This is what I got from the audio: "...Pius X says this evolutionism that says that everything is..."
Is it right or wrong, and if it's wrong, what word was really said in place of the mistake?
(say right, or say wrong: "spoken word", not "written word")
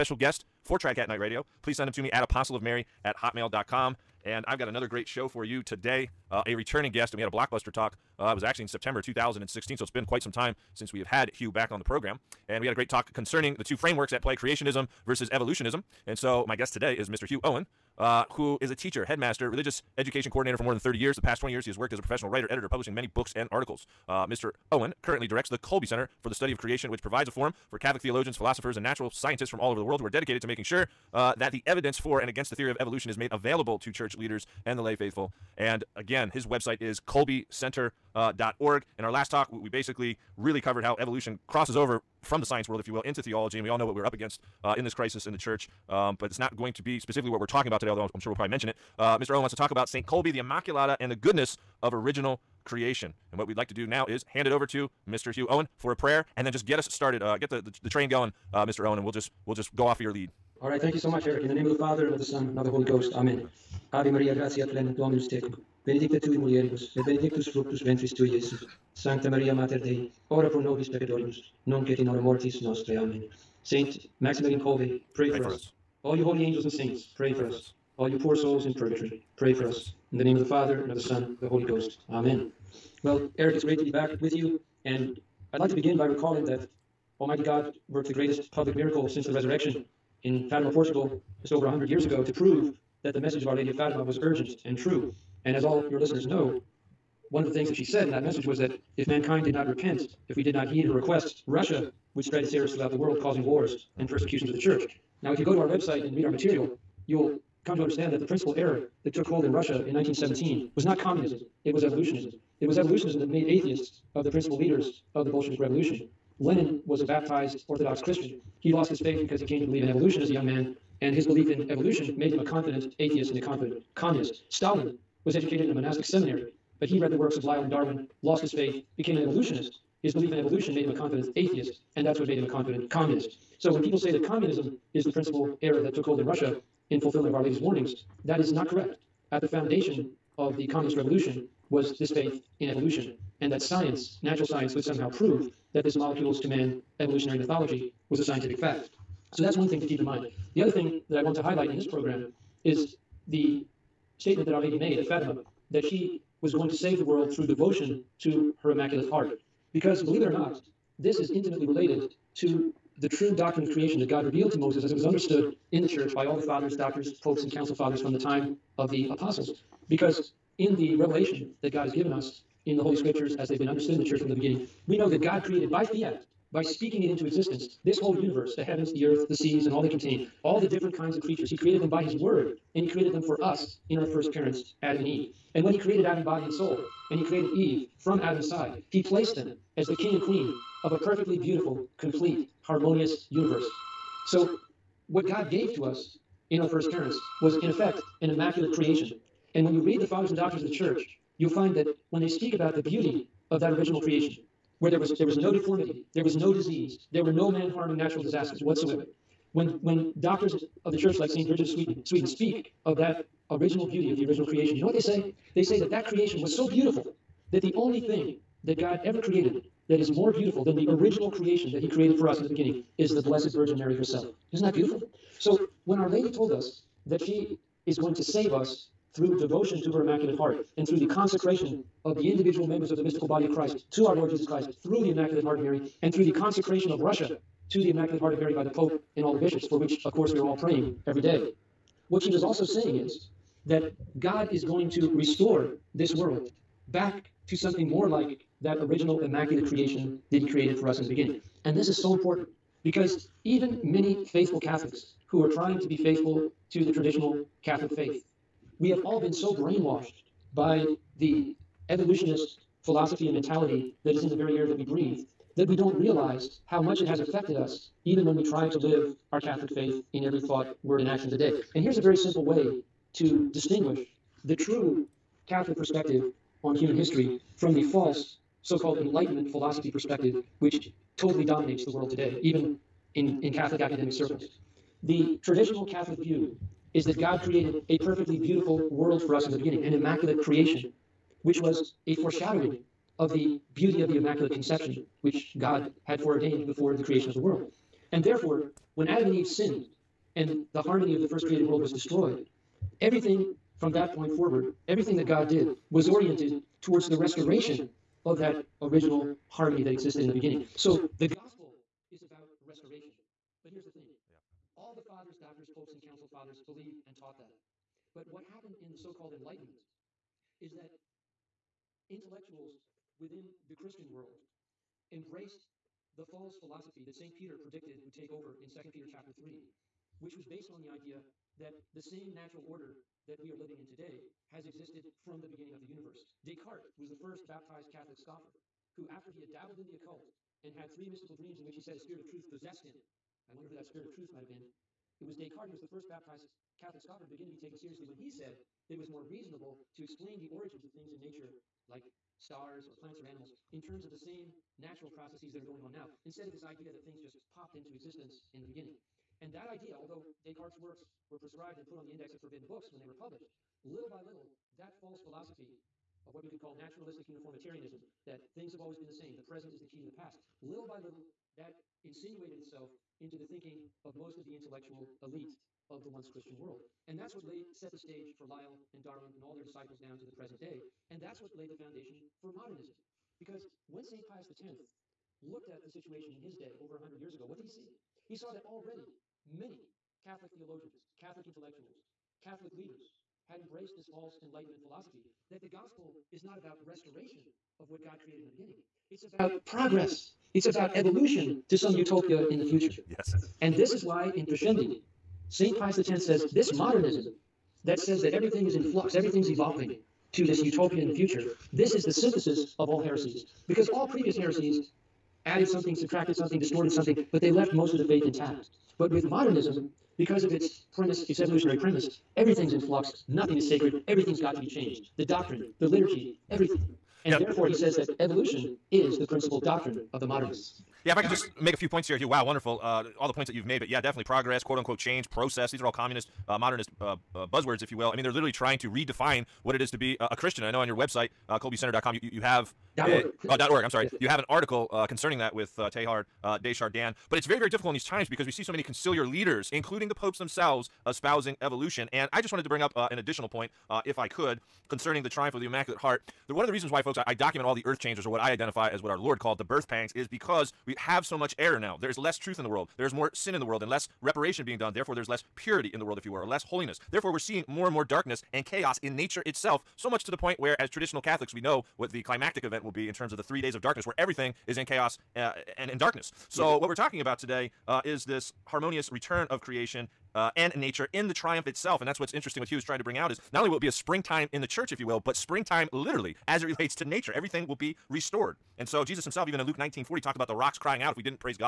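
wrong: "modernism", not "evolutionism".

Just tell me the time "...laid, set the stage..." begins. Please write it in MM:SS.
06:17.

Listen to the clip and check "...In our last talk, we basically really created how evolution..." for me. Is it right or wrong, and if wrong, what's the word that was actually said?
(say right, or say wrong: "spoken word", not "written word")
wrong: "covered", not "created".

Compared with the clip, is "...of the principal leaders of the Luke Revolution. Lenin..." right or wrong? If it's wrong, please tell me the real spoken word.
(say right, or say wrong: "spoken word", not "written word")
wrong: "Bolshevik", not "Luke".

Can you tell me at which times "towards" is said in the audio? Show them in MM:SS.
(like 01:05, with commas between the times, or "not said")
05:06.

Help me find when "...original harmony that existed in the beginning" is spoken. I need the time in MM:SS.
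05:08.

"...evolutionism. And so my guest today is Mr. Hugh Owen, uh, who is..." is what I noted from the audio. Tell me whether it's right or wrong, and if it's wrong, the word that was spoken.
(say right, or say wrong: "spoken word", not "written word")
right.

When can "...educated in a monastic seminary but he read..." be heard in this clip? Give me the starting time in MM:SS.
02:05.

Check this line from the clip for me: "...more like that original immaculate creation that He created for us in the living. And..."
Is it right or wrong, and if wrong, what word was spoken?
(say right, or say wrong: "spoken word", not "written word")
wrong: "beginning", not "living".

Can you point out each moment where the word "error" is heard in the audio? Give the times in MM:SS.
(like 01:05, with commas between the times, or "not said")
01:42, 01:48, 02:15, 07:41.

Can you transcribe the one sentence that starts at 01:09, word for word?
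Sancta Maria, Mater Dei, ora pro nobis peccatoribus, nunc et in hora mortis nostre.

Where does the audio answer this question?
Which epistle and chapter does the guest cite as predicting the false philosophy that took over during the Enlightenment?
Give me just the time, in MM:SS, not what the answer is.
05:28.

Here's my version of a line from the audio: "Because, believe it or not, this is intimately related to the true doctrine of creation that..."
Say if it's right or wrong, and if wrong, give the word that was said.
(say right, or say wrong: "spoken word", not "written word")
right.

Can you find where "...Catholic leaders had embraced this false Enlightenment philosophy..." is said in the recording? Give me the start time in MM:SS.
06:32.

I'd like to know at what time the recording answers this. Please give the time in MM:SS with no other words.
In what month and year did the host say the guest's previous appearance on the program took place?
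00:08.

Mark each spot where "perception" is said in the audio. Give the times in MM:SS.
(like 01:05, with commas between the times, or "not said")
not said.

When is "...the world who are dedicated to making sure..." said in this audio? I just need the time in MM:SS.
00:29.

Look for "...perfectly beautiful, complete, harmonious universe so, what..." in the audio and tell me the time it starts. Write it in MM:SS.
03:10.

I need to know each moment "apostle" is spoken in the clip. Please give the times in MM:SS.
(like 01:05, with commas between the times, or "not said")
00:02, 02:49.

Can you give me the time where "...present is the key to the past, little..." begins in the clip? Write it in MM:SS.
06:09.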